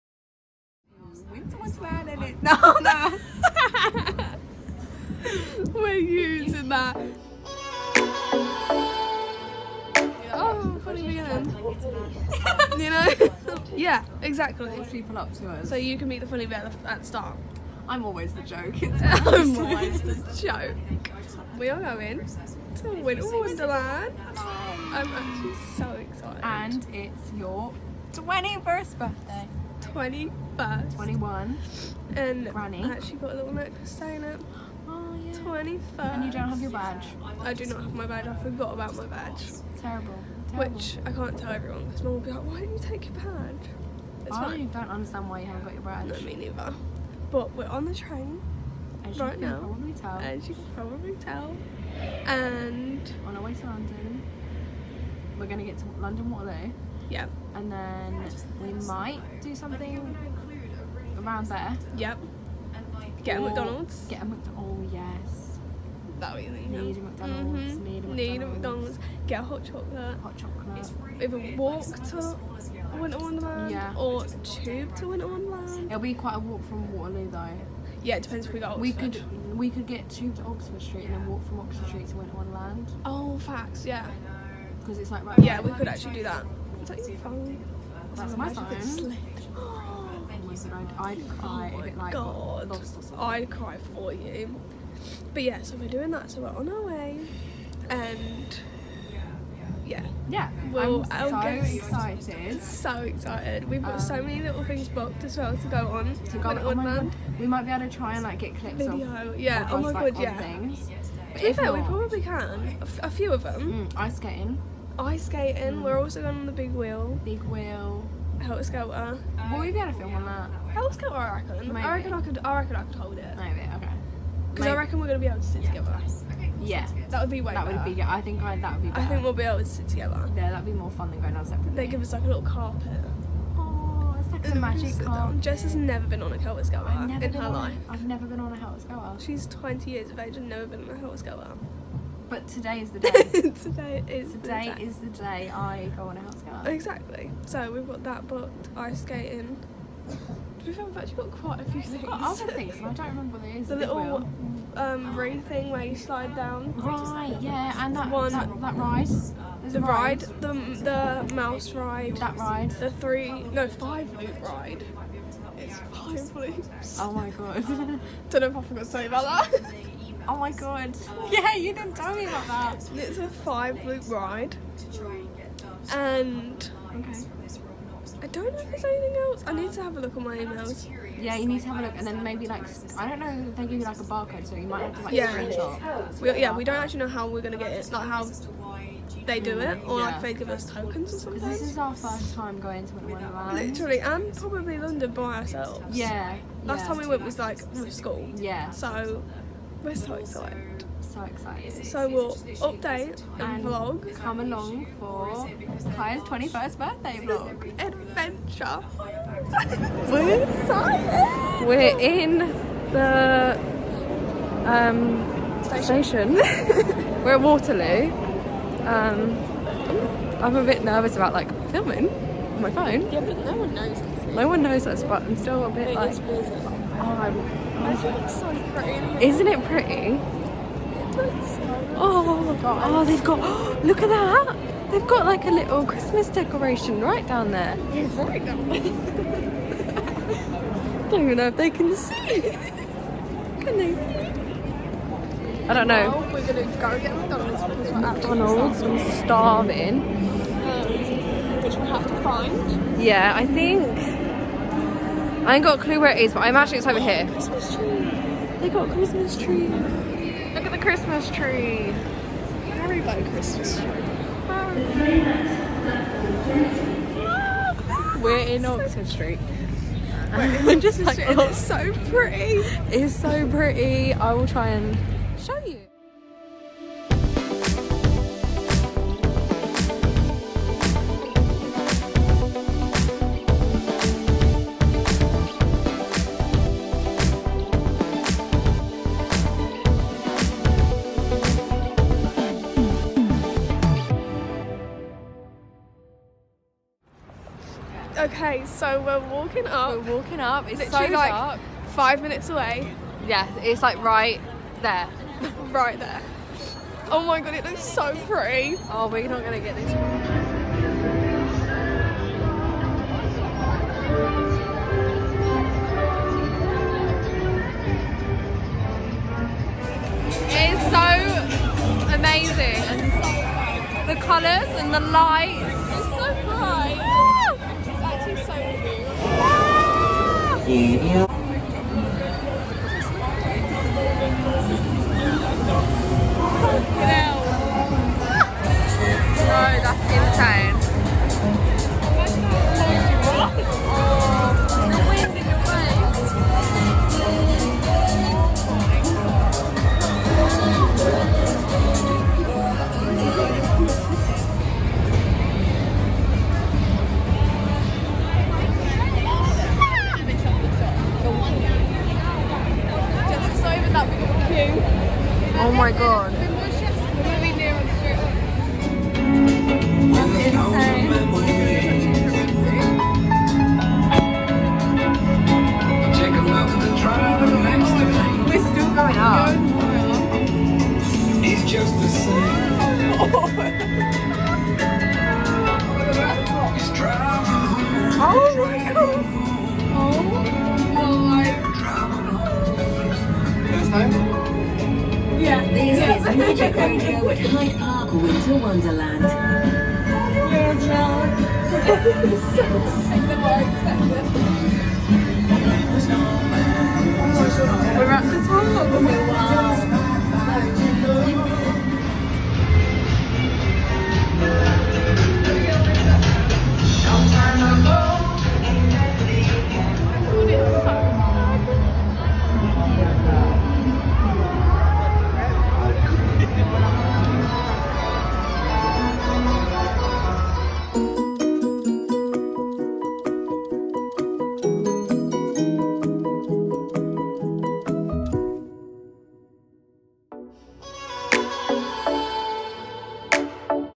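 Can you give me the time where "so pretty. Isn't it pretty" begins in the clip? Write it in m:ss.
3:48.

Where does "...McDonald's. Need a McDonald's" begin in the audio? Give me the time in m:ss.
1:08.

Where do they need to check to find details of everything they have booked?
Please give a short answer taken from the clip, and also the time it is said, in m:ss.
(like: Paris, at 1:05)
Emails, at 3:00.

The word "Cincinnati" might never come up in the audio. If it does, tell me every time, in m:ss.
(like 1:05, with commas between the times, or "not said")
not said.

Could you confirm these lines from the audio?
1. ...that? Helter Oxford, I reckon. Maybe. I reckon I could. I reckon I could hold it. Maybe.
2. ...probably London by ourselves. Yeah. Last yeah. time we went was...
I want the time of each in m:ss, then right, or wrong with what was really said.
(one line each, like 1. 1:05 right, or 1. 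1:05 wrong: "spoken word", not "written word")
1. 2:00 wrong: "Skelter", not "Oxford"
2. 3:14 right.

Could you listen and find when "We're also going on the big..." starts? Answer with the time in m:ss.
1:55.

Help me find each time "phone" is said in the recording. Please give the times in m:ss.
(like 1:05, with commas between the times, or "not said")
1:28, 3:42.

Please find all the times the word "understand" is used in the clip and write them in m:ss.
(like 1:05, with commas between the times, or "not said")
0:44.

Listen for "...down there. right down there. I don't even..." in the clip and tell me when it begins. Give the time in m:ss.
3:57.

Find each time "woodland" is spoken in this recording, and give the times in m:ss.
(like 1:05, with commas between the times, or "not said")
not said.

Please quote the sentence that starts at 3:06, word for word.
We, yeah, we don't actually know how we're gonna get it, like how they do it, or yeah.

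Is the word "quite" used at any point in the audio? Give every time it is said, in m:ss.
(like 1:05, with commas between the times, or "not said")
1:16, 2:31.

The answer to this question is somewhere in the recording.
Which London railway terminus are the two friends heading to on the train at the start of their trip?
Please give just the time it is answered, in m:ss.
0:55.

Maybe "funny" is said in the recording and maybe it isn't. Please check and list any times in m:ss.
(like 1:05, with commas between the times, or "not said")
0:10, 0:16.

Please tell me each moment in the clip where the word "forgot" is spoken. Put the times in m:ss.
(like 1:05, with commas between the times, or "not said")
0:38, 2:48.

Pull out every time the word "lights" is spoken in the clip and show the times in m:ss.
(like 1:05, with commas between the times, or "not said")
5:24.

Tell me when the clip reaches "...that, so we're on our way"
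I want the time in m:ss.
1:36.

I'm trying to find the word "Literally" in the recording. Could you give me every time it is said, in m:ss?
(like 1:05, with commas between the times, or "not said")
3:13, 5:00.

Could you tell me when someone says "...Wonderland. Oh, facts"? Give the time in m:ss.
1:22.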